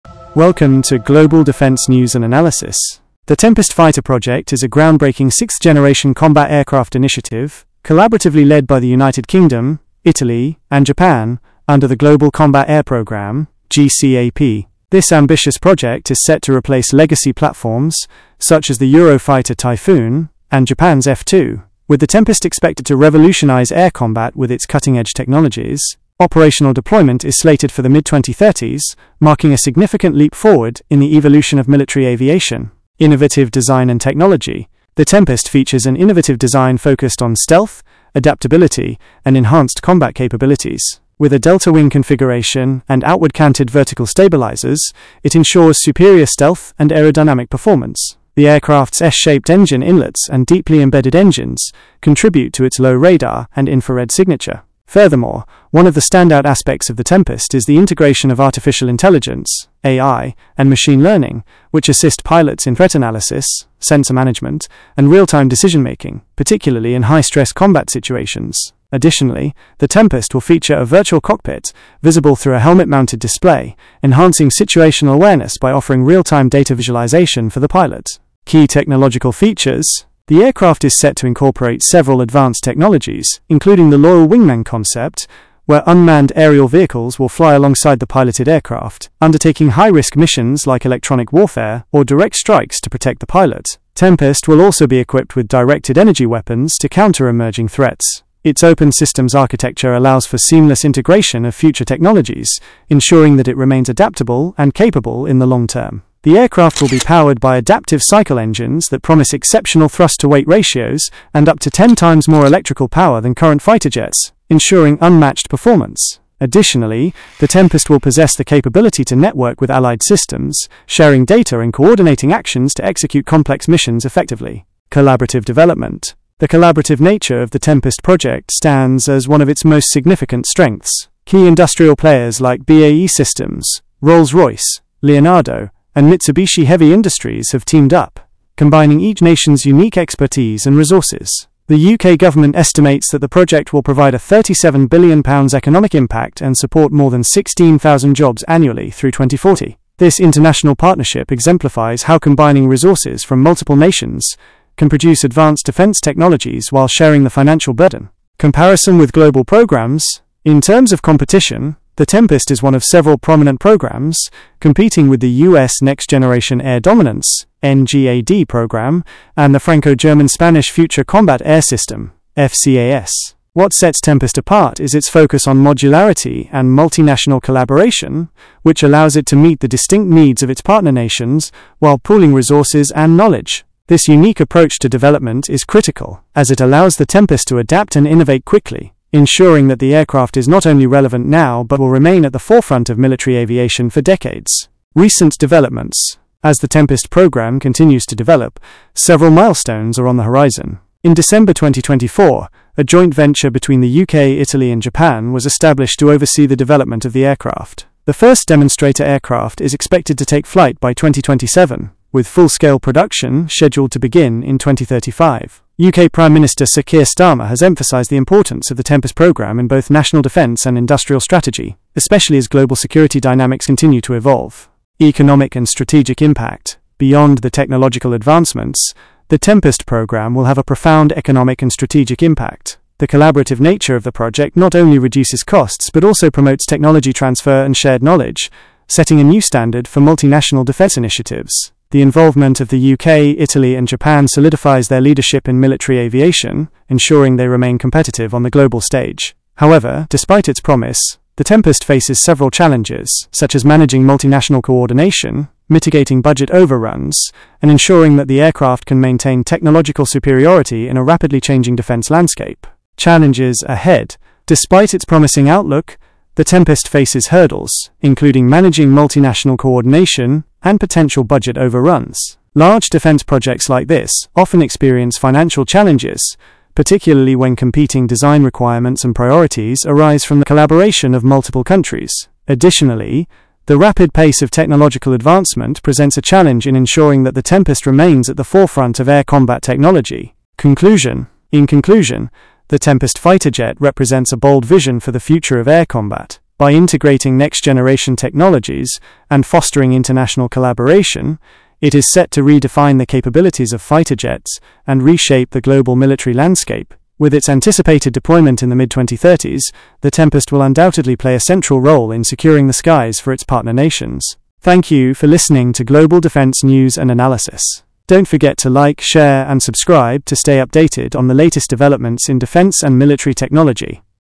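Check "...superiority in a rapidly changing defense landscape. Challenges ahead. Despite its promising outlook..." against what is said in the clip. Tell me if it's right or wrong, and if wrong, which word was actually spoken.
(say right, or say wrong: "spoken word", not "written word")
right.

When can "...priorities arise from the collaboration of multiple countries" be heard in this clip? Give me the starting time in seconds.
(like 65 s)
279 s.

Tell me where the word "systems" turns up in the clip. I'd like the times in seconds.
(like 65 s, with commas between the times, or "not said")
98 s, 120 s, 133 s, 171 s.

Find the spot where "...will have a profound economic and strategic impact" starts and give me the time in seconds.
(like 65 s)
230 s.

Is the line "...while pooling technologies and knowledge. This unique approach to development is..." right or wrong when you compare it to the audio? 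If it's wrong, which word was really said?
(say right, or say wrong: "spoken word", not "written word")
wrong: "resources", not "technologies".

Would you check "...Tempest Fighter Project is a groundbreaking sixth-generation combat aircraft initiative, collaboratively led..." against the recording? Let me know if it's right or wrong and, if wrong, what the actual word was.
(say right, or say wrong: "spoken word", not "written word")
right.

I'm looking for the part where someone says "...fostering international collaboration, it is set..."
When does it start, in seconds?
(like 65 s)
299 s.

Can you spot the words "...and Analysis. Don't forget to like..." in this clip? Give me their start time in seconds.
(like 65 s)
316 s.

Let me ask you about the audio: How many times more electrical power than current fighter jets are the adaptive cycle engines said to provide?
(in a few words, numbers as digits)
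10.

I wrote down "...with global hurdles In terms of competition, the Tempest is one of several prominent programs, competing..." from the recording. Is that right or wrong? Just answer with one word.
wrong.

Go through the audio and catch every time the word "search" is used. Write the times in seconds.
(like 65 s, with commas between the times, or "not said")
not said.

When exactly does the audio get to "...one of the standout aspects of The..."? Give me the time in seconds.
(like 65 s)
55 s.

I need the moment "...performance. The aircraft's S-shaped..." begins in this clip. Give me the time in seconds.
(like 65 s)
47 s.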